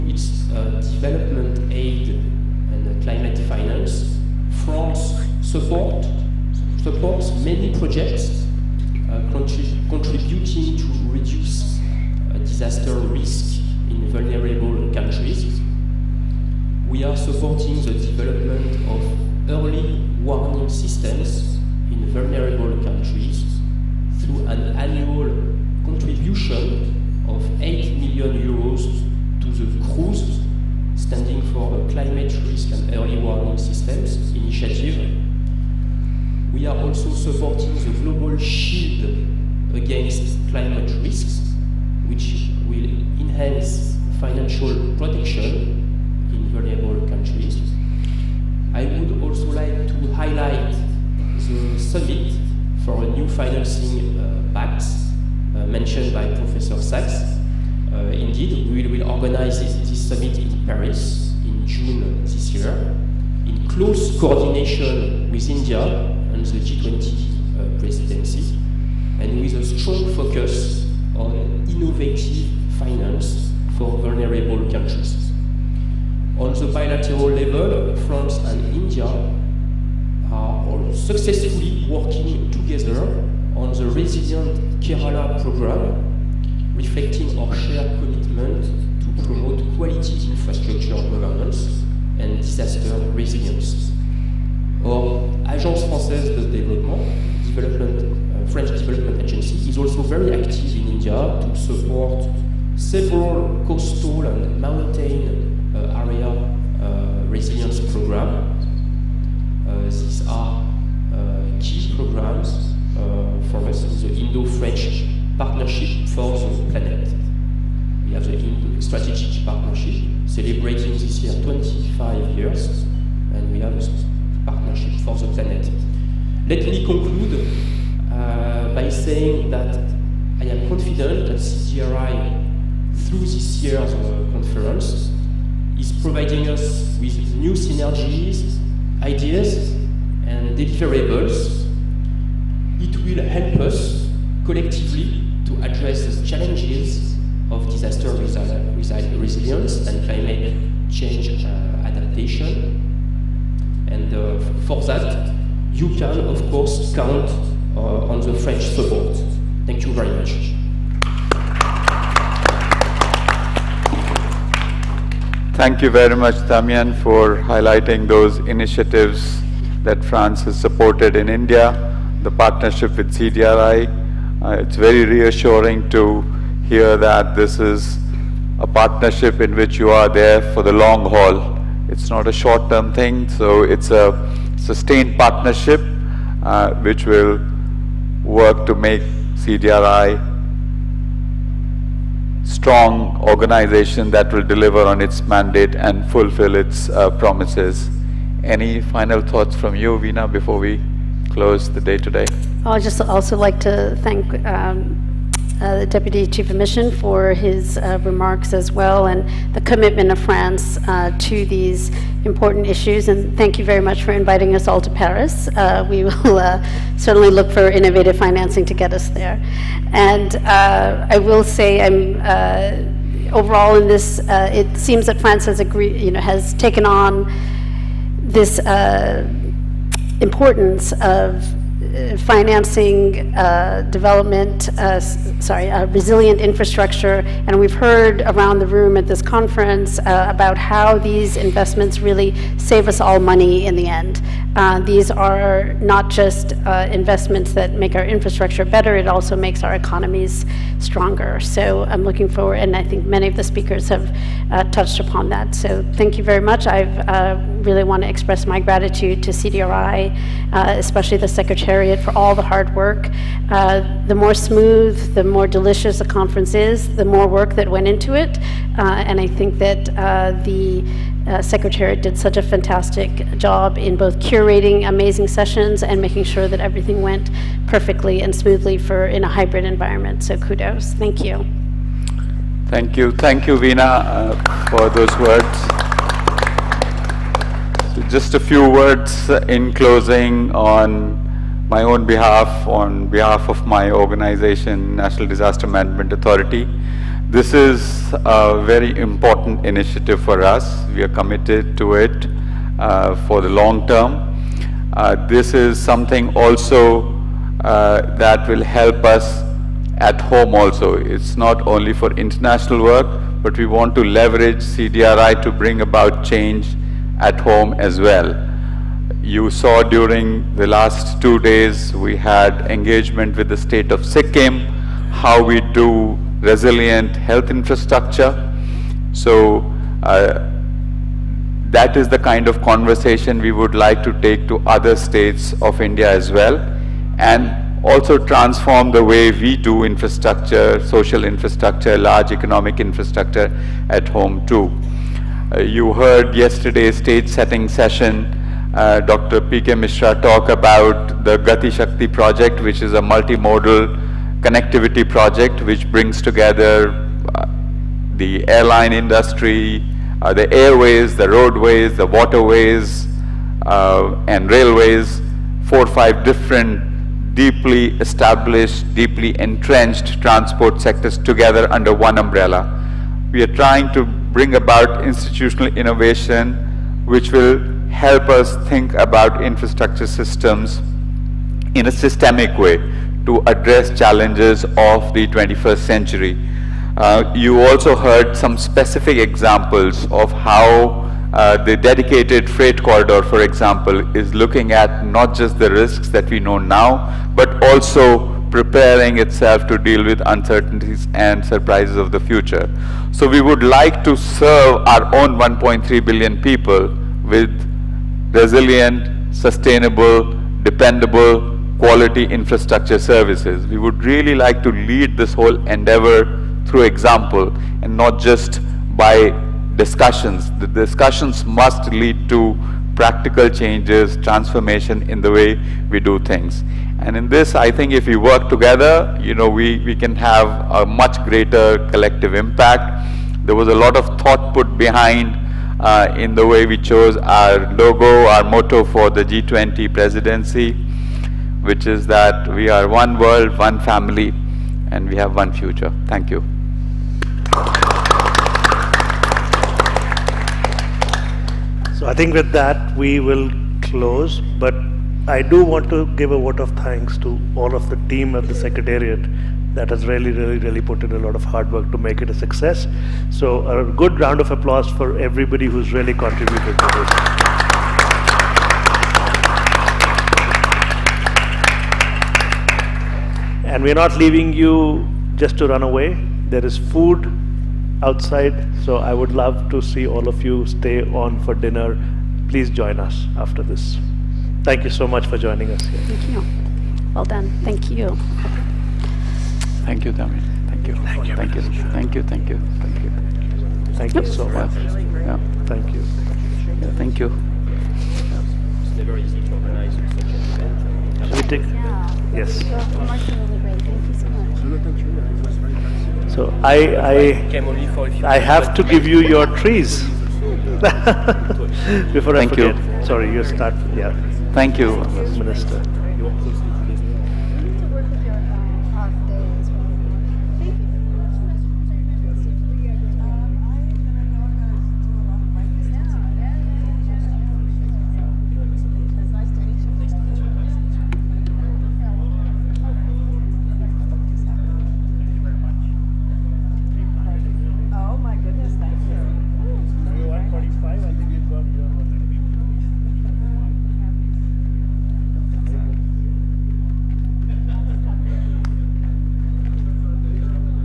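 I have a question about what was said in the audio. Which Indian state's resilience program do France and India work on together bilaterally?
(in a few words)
Kerala.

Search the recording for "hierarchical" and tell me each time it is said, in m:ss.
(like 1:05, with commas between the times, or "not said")
not said.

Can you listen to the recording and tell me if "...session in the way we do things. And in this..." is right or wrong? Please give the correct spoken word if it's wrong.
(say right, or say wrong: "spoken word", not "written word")
wrong: "transformation", not "session".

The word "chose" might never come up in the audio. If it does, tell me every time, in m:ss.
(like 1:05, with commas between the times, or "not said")
7:16.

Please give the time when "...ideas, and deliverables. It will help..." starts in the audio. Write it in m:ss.
2:19.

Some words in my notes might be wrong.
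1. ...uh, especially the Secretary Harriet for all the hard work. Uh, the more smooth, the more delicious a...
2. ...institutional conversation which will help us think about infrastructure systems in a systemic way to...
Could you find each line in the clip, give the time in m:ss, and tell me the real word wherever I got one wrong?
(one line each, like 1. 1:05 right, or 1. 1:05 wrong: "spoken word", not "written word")
1. 4:20 right
2. 6:15 wrong: "innovation", not "conversation".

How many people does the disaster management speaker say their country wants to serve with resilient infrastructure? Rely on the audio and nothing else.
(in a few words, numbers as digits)
1.3 billion.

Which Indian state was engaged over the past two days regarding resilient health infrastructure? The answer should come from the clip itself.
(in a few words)
Sikkim.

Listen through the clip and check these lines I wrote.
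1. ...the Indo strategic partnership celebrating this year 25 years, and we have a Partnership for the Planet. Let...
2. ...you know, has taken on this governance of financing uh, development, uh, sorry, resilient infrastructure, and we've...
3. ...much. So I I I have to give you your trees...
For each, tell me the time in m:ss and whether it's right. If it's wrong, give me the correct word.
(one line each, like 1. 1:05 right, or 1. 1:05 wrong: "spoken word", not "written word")
1. 1:58 right
2. 3:46 wrong: "importance", not "governance"
3. 8:23 right.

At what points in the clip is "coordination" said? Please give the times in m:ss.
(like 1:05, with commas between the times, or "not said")
1:04.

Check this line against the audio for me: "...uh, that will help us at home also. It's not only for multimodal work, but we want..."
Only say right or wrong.
wrong.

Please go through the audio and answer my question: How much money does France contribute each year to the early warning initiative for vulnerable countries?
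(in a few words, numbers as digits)
8 million euros.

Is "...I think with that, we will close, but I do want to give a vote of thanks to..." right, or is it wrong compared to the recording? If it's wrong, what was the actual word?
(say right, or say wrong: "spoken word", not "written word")
right.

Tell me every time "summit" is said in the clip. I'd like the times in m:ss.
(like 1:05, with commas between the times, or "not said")
0:51, 1:00.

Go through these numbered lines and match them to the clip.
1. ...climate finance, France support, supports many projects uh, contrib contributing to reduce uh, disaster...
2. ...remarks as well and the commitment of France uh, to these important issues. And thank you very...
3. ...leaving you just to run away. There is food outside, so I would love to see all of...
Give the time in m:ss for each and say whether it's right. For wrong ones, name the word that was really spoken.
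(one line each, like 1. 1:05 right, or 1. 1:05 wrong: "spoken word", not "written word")
1. 0:03 right
2. 3:28 right
3. 7:54 right.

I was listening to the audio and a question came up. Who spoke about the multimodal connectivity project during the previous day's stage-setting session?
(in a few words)
Dr. P.K. Mishra.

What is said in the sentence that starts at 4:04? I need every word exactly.
these are not just investments that make our infrastructure better, it also makes our economies stronger.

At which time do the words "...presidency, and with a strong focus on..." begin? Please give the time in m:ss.
1:07.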